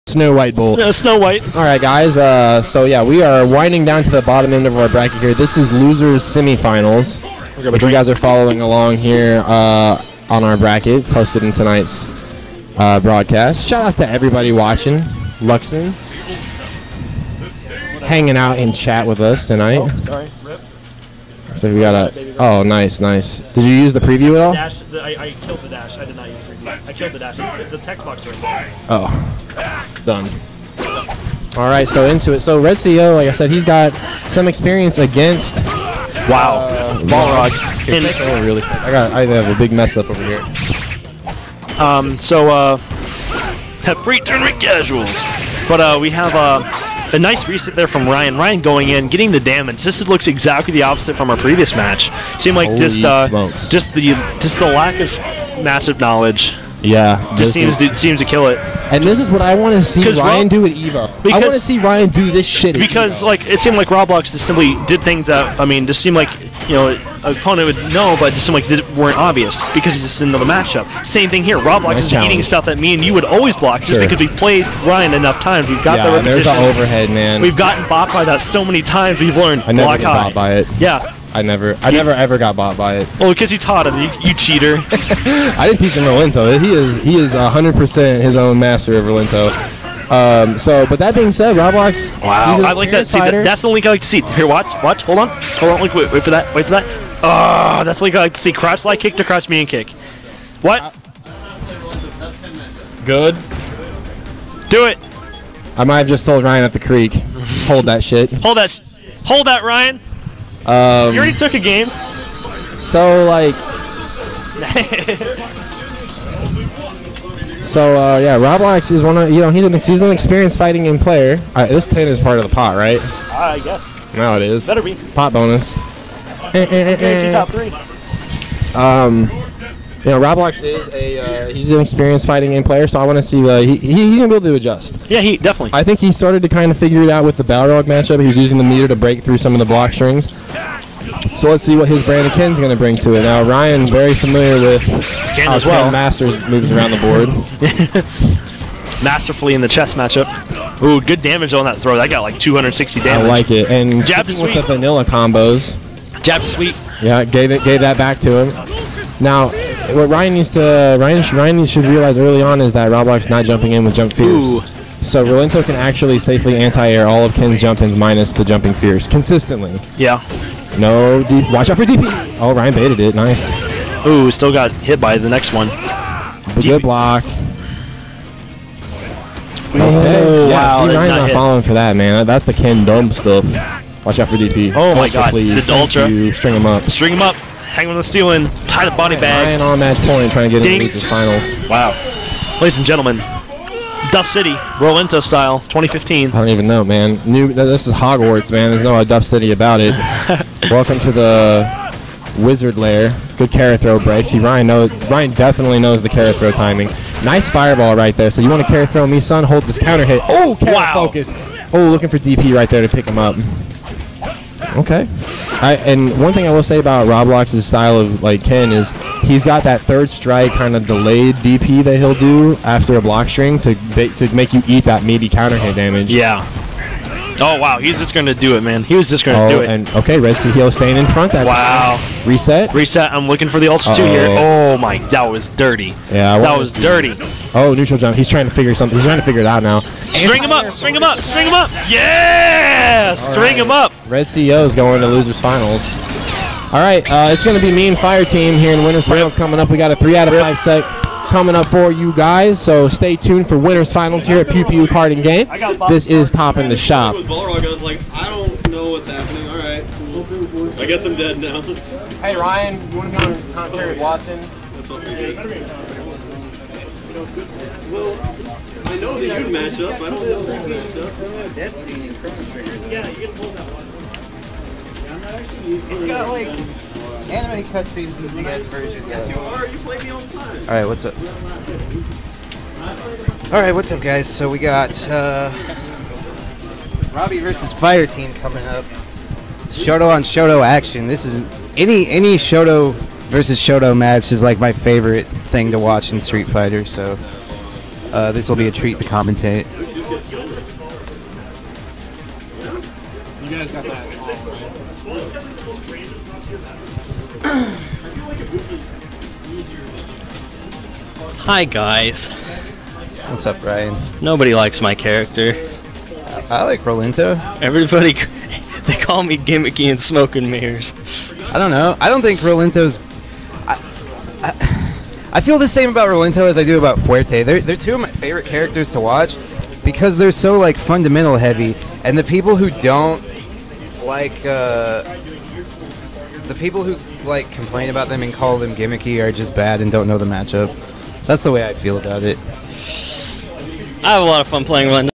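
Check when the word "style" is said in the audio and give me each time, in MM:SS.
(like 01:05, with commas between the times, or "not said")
03:15, 03:37.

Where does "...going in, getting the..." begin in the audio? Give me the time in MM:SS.
00:48.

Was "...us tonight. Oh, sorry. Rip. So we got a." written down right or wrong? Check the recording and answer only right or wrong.
right.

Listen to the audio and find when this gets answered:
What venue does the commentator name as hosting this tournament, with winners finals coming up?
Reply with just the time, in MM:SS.
04:14.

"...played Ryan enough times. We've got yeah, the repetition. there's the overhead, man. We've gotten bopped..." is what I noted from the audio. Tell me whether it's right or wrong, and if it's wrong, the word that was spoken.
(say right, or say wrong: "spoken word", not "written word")
right.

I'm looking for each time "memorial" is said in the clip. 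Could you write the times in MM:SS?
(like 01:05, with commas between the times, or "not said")
not said.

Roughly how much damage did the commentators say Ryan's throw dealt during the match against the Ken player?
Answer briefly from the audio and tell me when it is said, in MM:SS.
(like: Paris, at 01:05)
260, at 02:32.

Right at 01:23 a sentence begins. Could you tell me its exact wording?
Oh, because you taught him, you, you cheater.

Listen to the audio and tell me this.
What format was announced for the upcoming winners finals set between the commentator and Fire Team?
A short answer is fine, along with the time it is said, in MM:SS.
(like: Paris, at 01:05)
three out of five, at 04:09.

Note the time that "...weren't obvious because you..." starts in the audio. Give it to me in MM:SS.
01:08.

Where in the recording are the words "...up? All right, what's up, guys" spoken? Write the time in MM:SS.
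04:41.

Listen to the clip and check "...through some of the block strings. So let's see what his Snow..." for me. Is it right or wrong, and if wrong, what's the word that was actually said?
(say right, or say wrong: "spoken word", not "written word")
wrong: "Brandon", not "Snow".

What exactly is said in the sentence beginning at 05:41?
That's the way I feel about it.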